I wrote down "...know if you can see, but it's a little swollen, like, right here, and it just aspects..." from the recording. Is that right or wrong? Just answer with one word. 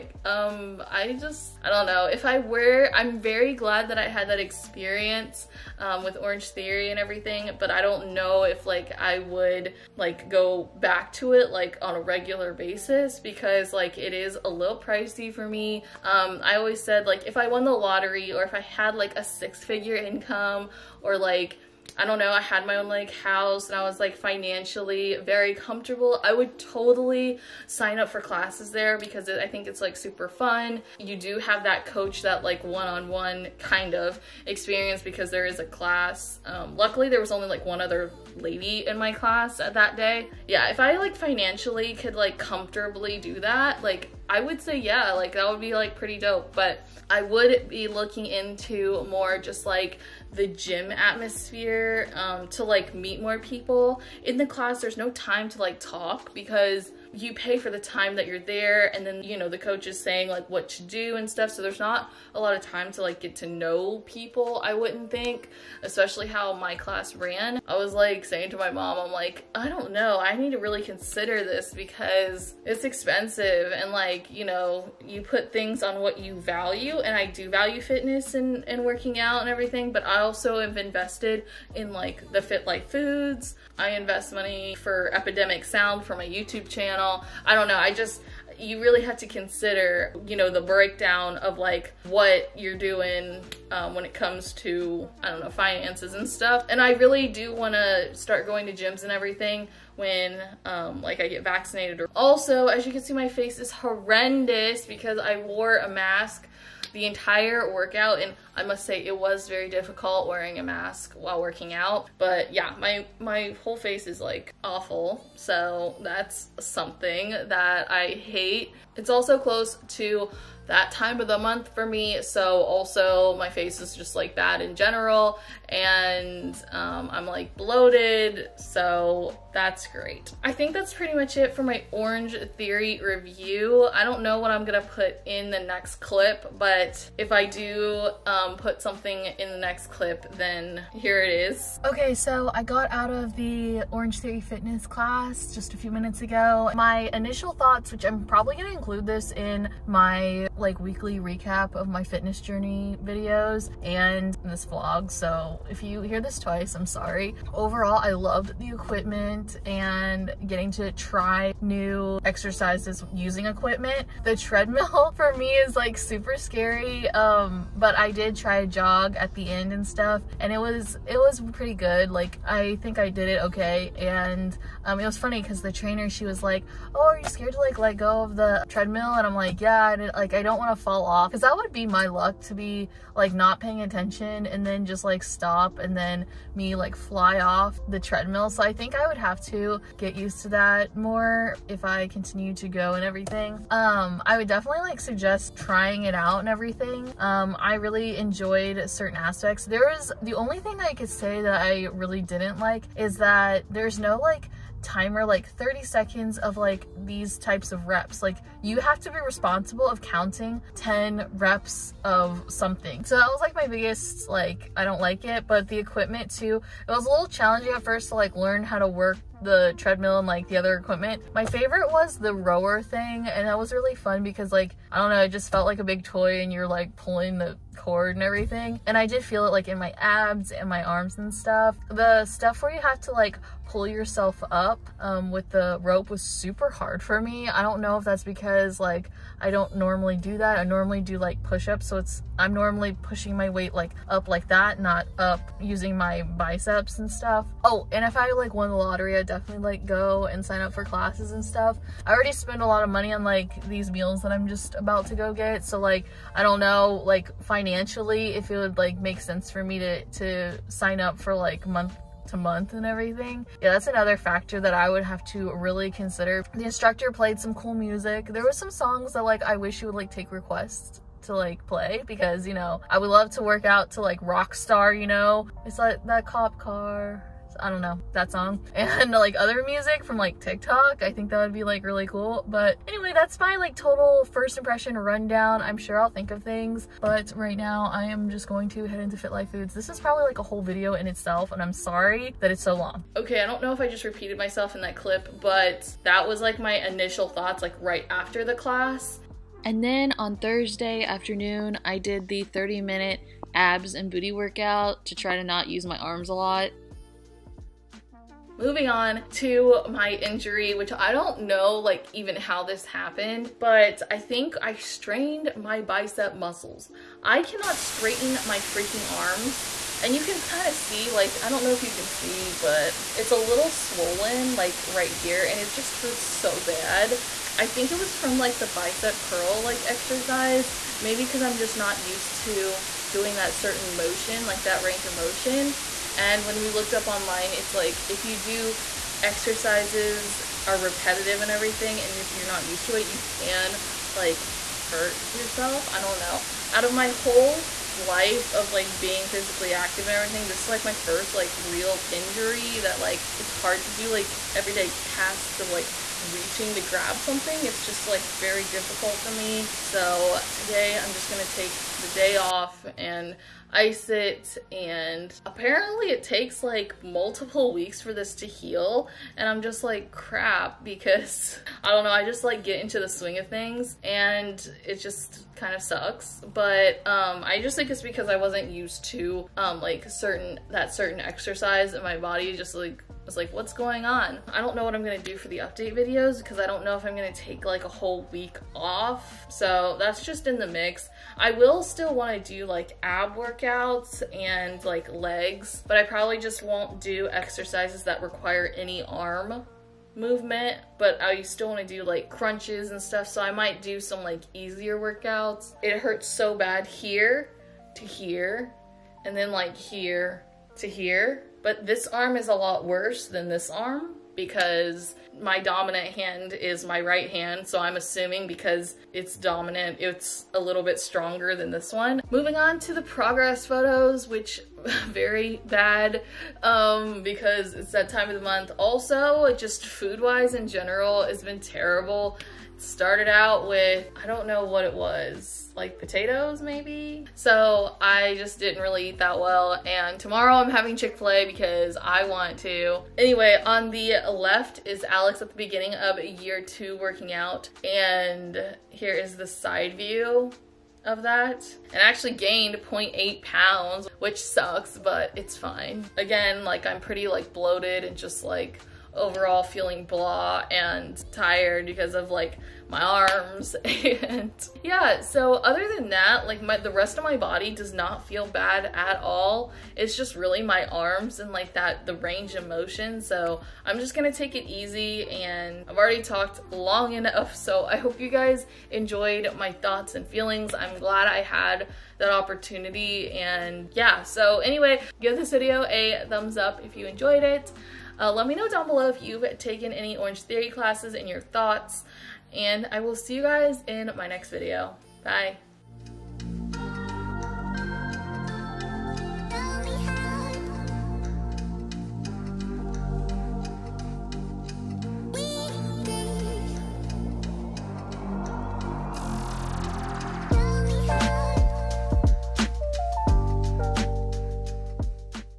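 wrong.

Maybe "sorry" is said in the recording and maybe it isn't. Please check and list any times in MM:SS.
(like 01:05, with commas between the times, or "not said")
02:36, 04:51.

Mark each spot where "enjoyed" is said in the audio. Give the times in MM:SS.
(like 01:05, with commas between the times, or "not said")
03:18, 07:58, 08:07.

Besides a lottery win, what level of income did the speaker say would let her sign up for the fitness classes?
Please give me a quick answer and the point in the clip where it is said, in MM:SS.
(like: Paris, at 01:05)
Six figure income, at 00:19.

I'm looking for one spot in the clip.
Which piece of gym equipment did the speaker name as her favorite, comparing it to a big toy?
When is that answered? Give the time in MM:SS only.
03:42.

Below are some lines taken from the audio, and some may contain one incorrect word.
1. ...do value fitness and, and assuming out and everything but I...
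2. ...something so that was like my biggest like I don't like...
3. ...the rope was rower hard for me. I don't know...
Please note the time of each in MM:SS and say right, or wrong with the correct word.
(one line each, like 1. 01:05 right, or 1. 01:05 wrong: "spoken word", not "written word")
1. 01:17 wrong: "working", not "assuming"
2. 03:32 right
3. 03:55 wrong: "super", not "rower".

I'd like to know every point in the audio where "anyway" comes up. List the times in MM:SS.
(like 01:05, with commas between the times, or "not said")
04:42, 07:23, 08:04.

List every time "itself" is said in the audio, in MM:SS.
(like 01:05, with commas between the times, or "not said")
04:51.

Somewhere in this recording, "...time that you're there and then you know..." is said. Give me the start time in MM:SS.
00:57.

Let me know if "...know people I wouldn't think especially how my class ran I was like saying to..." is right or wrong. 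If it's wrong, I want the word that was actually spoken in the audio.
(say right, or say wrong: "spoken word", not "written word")
right.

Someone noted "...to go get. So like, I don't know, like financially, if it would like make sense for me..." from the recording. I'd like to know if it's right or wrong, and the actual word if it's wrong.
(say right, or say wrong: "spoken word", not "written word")
right.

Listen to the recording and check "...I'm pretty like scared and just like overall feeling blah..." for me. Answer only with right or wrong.
wrong.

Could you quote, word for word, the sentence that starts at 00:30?
You do have that coach, that like one-on-one -on -one kind of experience because there is a class.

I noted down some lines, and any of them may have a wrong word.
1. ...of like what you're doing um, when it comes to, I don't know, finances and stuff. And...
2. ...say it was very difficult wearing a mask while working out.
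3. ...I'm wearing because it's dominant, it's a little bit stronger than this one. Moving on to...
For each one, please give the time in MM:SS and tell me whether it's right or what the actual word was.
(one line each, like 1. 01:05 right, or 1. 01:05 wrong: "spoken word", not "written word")
1. 01:31 right
2. 01:48 right
3. 06:57 wrong: "assuming", not "wearing".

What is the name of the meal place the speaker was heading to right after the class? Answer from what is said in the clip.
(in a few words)
Fit Life Foods.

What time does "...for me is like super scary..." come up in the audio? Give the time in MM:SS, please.
02:45.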